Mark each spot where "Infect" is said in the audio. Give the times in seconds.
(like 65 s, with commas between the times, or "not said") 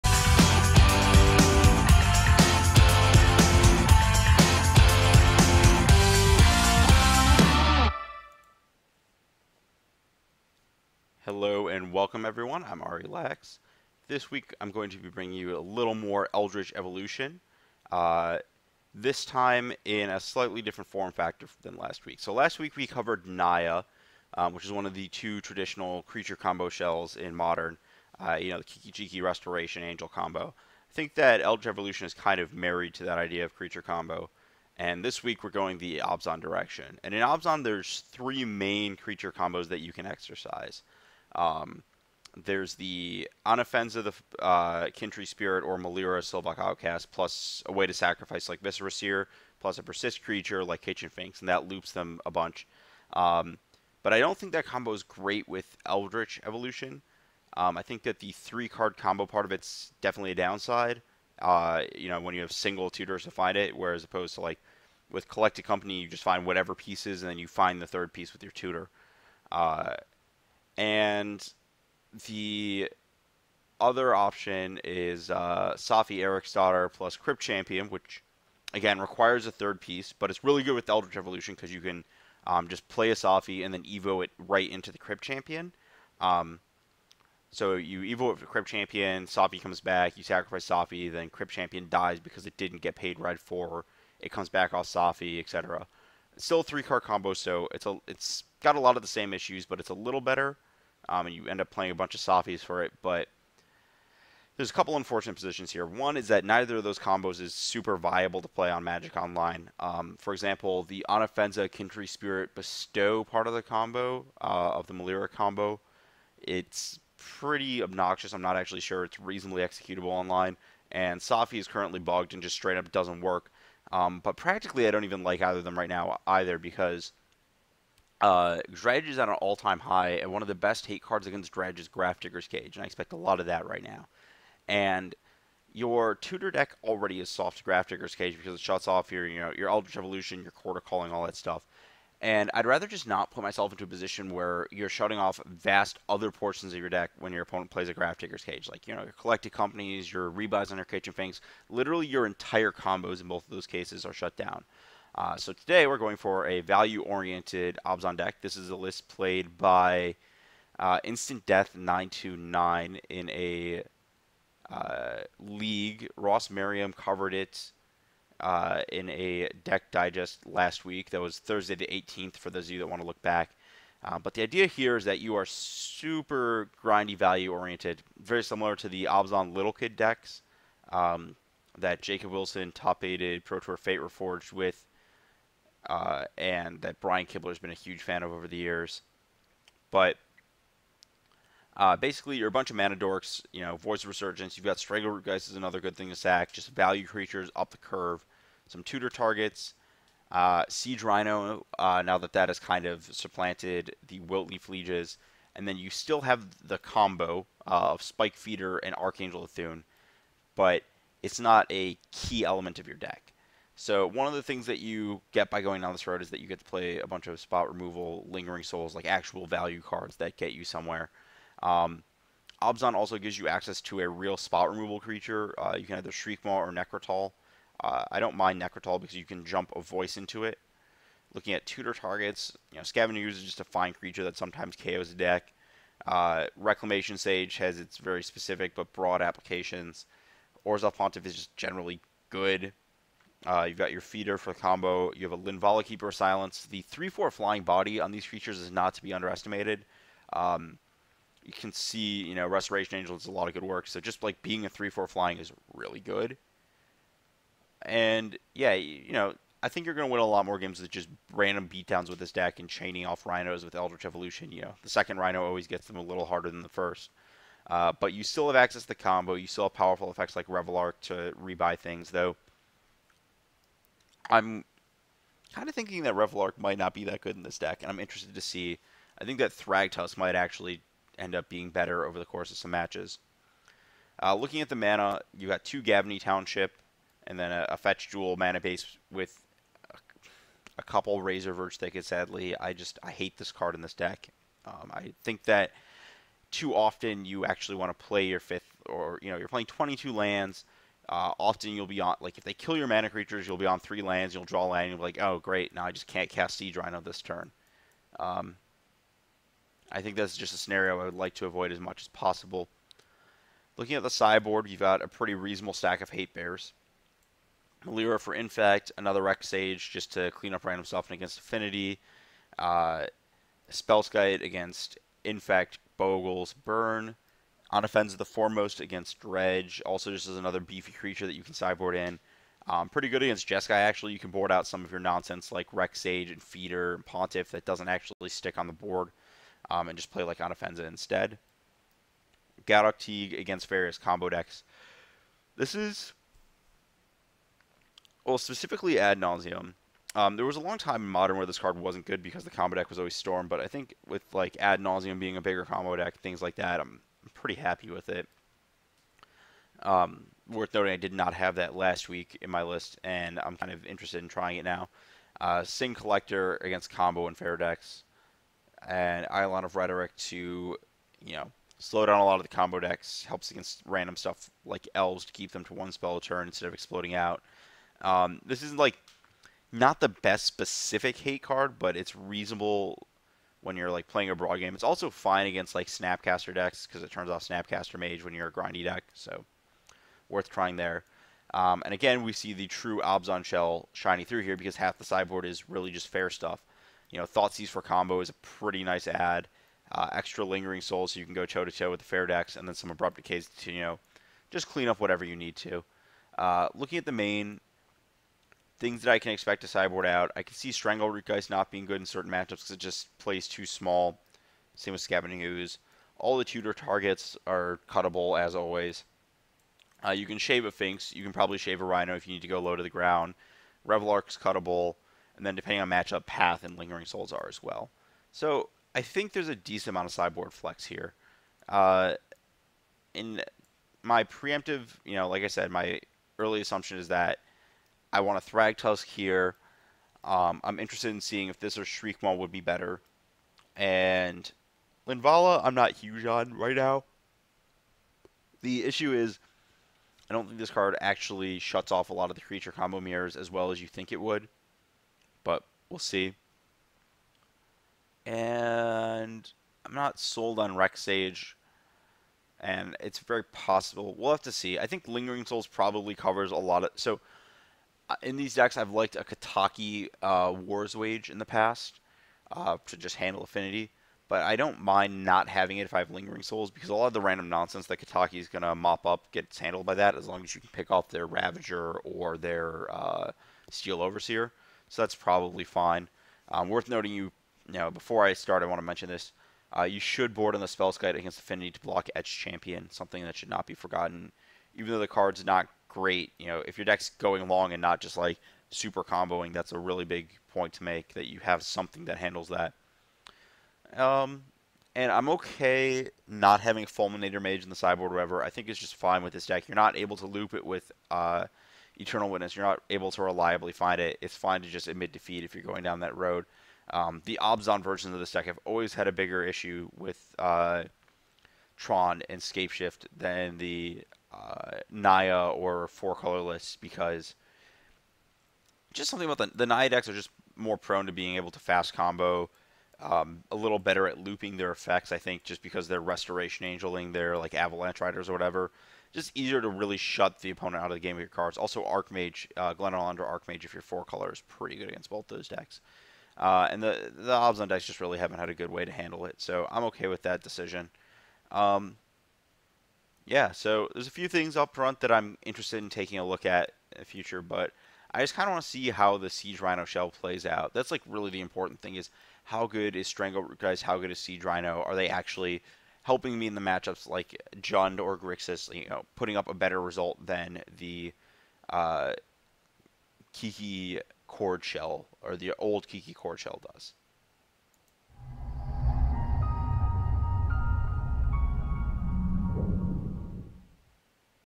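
318 s, 325 s.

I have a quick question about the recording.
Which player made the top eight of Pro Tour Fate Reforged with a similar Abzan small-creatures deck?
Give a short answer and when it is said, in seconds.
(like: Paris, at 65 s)
Jacob Wilson, at 182 s.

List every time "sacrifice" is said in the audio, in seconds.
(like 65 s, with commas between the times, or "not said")
47 s, 90 s.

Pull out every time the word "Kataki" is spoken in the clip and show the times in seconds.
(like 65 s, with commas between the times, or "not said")
469 s, 477 s.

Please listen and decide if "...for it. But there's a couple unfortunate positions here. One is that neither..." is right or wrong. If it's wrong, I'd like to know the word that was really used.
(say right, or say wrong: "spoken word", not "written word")
right.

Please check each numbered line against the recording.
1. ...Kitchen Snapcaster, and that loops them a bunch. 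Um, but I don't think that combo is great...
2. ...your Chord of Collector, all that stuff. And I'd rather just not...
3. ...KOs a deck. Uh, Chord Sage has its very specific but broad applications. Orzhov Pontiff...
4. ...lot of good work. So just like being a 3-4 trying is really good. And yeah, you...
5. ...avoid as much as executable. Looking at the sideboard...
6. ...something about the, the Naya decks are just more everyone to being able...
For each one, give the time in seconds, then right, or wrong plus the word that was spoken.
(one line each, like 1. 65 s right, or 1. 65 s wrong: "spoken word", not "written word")
1. 50 s wrong: "Finks", not "Snapcaster"
2. 140 s wrong: "Calling", not "Collector"
3. 234 s wrong: "Reclamation", not "Chord"
4. 253 s wrong: "flying", not "trying"
5. 311 s wrong: "possible", not "executable"
6. 529 s wrong: "prone", not "everyone".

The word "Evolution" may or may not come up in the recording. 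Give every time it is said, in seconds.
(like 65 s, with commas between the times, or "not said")
16 s, 31 s, 56 s, 81 s, 139 s, 264 s.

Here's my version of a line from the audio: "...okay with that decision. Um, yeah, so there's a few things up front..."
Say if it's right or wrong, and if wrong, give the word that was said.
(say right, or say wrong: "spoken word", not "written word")
right.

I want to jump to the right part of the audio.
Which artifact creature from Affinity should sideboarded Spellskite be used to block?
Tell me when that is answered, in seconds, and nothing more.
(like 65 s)
492 s.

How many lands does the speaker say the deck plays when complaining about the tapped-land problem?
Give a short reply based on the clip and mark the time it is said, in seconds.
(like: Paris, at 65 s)
22, at 299 s.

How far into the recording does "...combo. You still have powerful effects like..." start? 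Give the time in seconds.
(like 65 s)
268 s.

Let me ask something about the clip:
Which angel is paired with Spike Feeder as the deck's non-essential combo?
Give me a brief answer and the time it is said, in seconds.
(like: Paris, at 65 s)
Archangel Thune, at 208 s.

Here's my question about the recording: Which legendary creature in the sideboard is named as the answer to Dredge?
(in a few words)
Anafenza, the Foremost.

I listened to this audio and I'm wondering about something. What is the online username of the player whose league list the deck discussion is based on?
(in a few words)
Instant Death 929.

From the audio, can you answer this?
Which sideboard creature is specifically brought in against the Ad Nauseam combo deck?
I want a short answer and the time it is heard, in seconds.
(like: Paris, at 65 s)
Gaddock Teeg, at 342 s.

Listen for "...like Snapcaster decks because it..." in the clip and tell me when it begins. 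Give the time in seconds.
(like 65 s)
385 s.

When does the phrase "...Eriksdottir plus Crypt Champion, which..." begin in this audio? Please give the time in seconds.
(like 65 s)
76 s.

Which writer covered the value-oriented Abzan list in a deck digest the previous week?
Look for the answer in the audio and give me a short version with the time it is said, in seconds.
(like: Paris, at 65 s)
Ross Merriam, at 166 s.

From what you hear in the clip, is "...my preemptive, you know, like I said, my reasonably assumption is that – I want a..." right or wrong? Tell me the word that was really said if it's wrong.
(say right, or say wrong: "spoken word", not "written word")
wrong: "early", not "reasonably".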